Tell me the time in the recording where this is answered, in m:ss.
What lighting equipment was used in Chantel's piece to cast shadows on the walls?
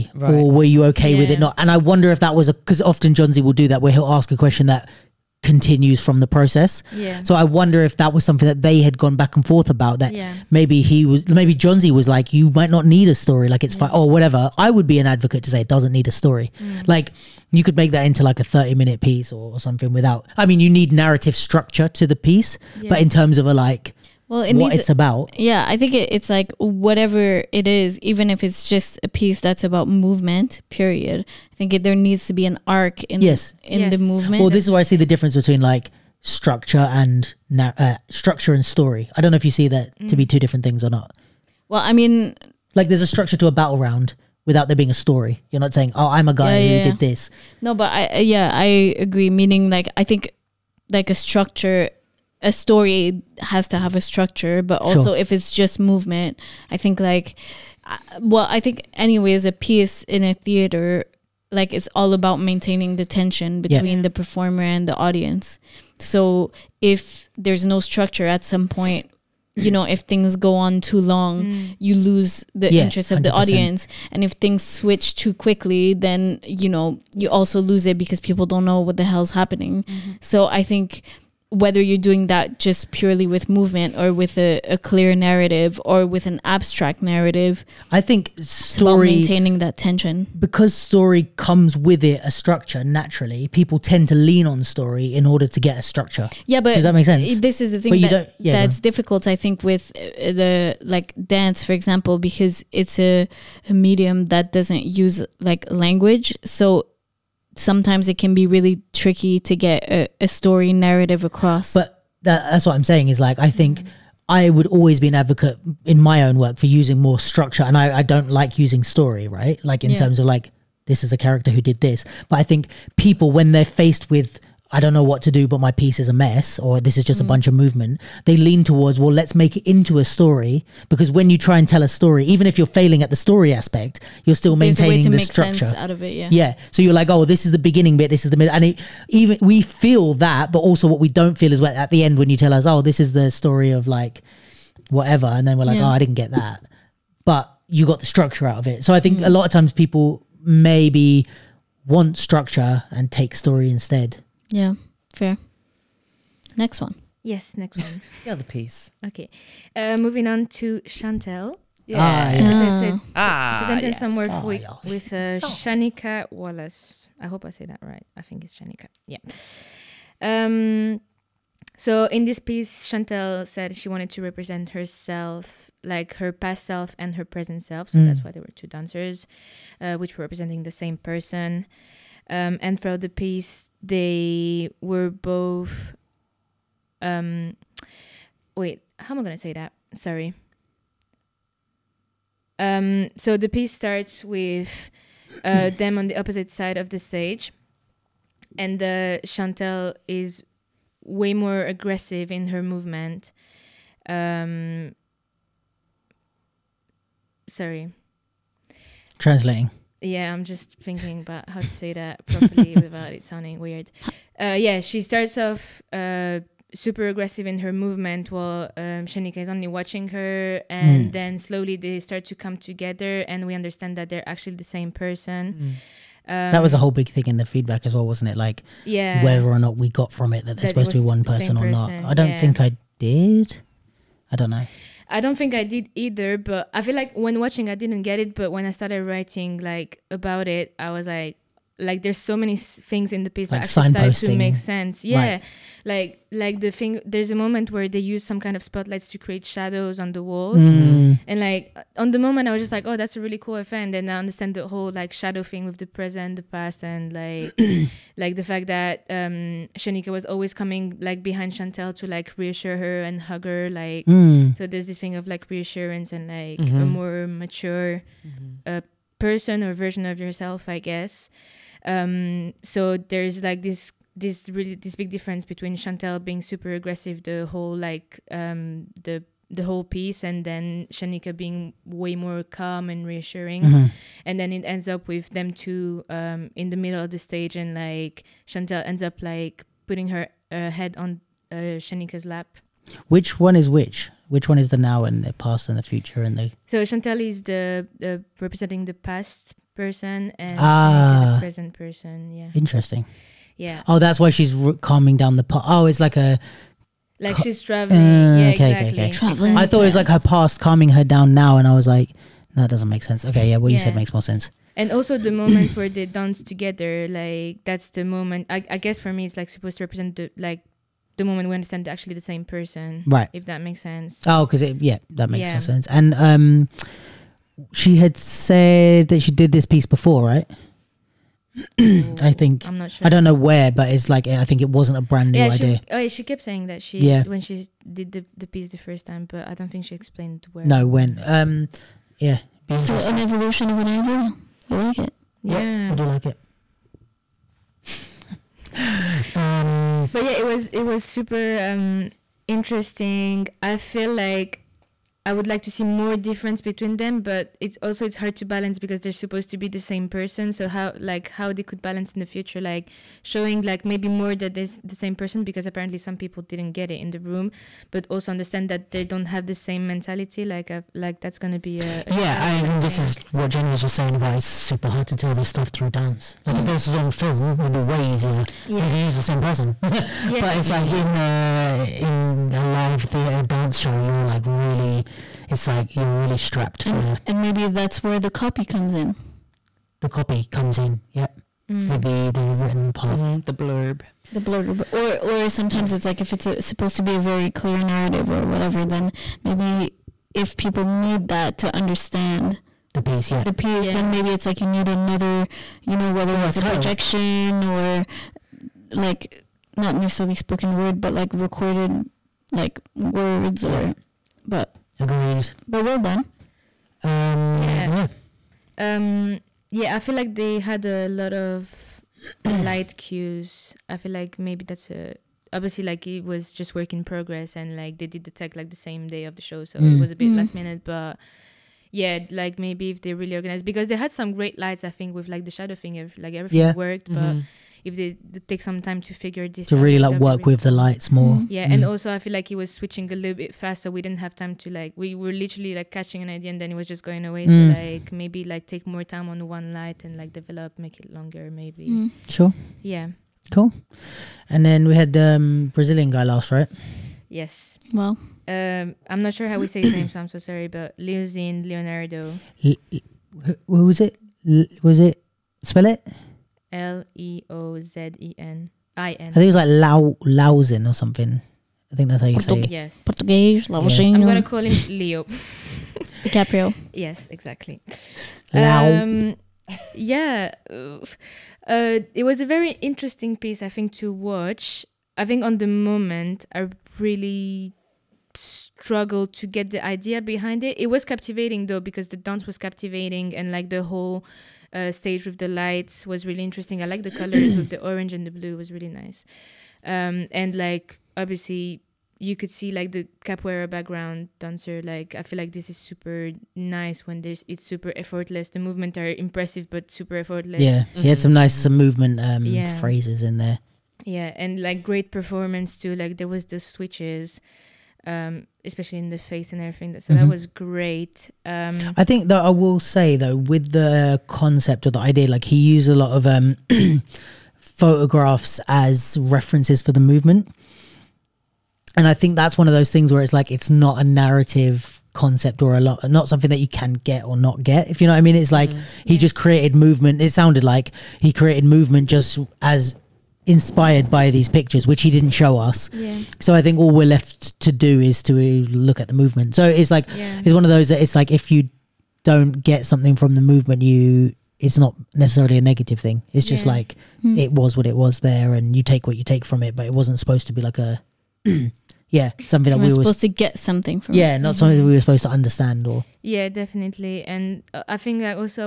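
4:08.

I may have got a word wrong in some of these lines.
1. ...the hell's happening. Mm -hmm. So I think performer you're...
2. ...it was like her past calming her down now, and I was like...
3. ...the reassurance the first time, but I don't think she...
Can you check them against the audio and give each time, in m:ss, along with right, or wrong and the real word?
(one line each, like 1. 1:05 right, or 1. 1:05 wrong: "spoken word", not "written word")
1. 1:18 wrong: "whether", not "performer"
2. 5:09 right
3. 5:38 wrong: "piece", not "reassurance".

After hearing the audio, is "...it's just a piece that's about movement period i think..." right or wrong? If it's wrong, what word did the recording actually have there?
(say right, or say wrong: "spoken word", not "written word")
right.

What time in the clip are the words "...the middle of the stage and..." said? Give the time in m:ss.
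4:46.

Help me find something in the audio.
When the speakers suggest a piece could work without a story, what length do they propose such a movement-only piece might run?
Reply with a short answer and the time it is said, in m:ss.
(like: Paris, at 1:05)
30 minutes, at 0:18.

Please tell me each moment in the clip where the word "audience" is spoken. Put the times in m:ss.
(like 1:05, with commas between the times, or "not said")
1:04, 1:13.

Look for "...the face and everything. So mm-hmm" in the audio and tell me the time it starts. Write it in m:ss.
8:39.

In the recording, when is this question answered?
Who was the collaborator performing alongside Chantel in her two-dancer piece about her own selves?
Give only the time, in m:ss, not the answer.
2:45.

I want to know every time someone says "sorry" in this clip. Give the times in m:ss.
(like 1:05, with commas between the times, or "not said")
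3:09, 3:27, 7:40.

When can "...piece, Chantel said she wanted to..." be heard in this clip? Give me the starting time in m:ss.
2:52.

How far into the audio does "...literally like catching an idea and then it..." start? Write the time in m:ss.
7:25.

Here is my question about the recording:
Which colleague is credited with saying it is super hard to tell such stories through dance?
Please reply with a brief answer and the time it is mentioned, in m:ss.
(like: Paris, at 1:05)
Jen, at 6:13.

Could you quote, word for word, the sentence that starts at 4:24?
so there's this thing of like reassurance and like mm -hmm.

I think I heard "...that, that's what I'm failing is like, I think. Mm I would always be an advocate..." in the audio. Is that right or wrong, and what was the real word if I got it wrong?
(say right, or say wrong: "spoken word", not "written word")
wrong: "saying", not "failing".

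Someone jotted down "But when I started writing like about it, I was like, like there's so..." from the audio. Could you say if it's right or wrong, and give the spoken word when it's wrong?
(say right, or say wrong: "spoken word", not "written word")
right.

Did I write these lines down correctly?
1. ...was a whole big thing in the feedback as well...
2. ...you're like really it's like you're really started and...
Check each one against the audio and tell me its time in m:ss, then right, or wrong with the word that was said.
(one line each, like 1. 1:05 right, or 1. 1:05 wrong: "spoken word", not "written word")
1. 3:46 right
2. 6:23 wrong: "strapped", not "started".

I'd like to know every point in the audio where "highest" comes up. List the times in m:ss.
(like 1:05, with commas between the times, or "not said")
not said.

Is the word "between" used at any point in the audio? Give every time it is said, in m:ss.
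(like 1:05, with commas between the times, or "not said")
0:35, 1:03, 4:35, 5:56.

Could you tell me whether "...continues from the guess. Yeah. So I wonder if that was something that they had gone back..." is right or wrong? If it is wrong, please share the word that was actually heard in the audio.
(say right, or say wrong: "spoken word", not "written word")
wrong: "process", not "guess".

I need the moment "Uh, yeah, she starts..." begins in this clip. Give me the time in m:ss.
3:34.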